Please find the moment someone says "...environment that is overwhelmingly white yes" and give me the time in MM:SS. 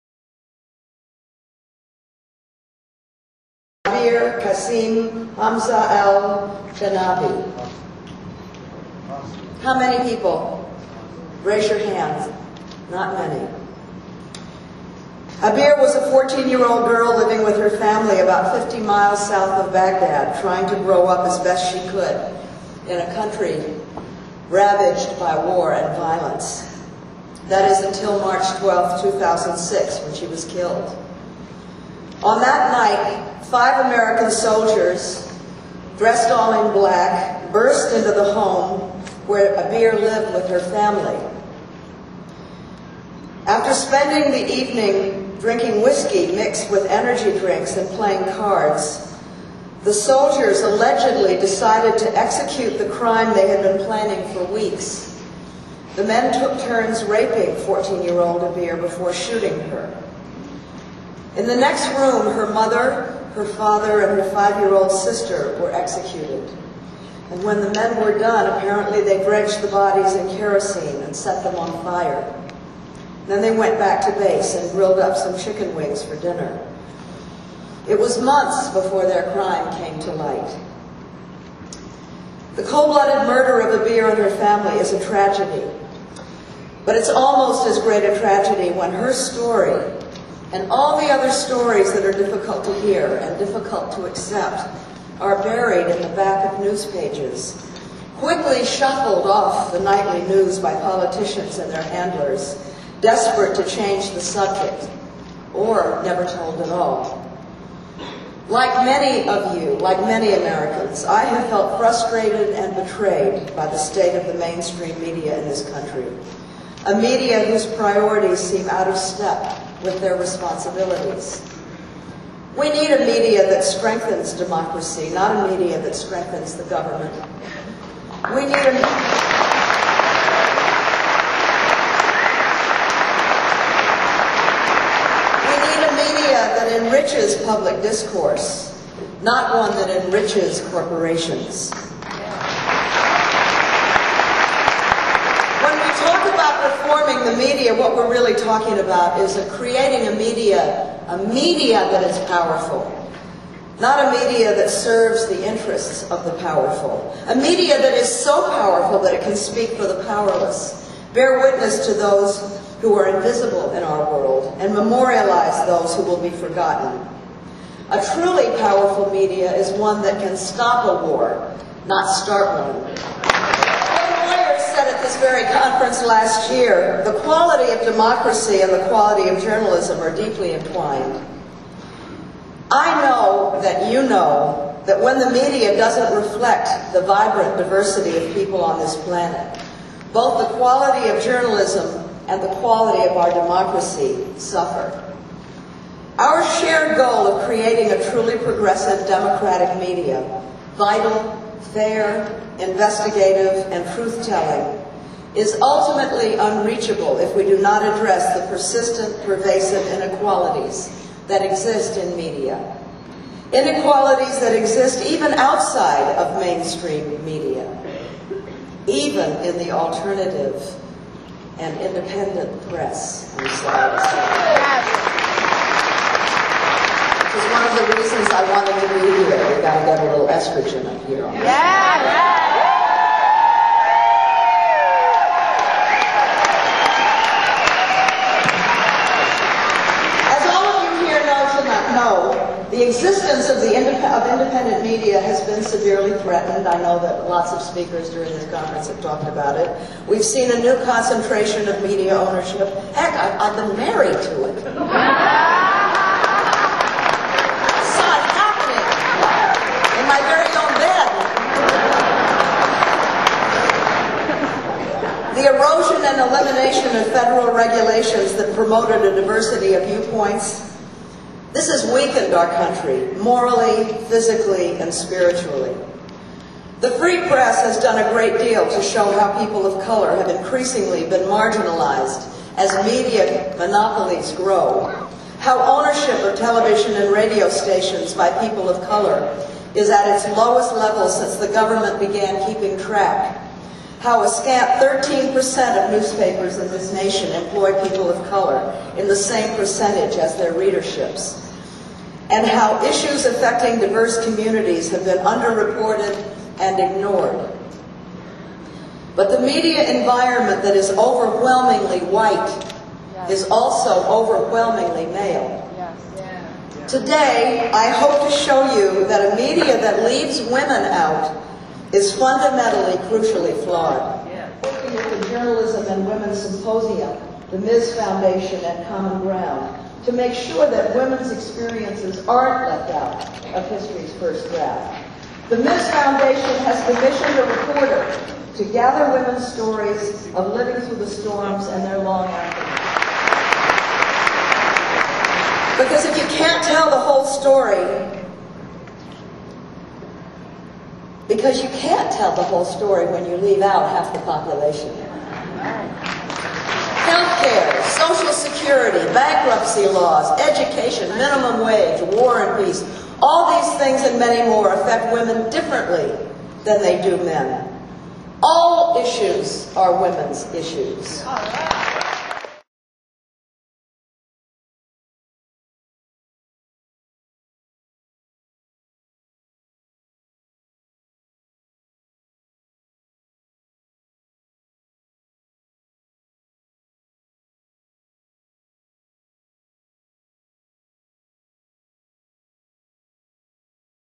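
05:09.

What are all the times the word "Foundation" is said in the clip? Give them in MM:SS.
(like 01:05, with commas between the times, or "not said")
05:27, 05:35.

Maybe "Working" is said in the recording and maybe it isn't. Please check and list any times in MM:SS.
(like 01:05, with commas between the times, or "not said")
05:24.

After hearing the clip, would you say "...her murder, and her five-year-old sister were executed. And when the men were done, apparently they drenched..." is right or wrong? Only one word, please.
wrong.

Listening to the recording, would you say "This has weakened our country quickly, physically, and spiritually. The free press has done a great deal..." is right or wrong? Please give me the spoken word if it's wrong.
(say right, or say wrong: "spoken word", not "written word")
wrong: "morally", not "quickly".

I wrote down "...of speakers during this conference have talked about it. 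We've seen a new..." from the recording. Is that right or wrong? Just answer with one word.
right.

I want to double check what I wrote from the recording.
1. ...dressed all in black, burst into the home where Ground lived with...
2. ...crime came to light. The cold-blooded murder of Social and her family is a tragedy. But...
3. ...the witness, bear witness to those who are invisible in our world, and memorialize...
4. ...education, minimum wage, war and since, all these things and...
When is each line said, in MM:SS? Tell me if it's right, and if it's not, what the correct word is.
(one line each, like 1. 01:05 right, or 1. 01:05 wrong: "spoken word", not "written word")
1. 00:35 wrong: "Abir", not "Ground"
2. 01:19 wrong: "Abir", not "Social"
3. 02:39 wrong: "powerless", not "witness"
4. 06:00 wrong: "peace", not "since".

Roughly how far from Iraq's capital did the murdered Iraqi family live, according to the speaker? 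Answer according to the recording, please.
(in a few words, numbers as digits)
50 miles.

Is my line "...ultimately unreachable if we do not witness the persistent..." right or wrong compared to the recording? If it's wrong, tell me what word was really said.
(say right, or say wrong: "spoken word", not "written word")
wrong: "address", not "witness".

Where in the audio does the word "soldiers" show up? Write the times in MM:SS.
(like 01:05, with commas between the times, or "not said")
00:34, 00:49.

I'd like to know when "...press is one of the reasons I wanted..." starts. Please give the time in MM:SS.
03:42.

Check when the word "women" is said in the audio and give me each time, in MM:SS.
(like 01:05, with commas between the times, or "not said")
05:20, 05:26, 05:30, 05:39, 06:05, 06:10.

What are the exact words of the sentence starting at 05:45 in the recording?
Because if you can't tell the whole story, Because you can't tell the whole story when you leave out half the population.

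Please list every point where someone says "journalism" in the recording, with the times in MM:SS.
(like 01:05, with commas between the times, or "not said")
02:59, 03:11, 05:25.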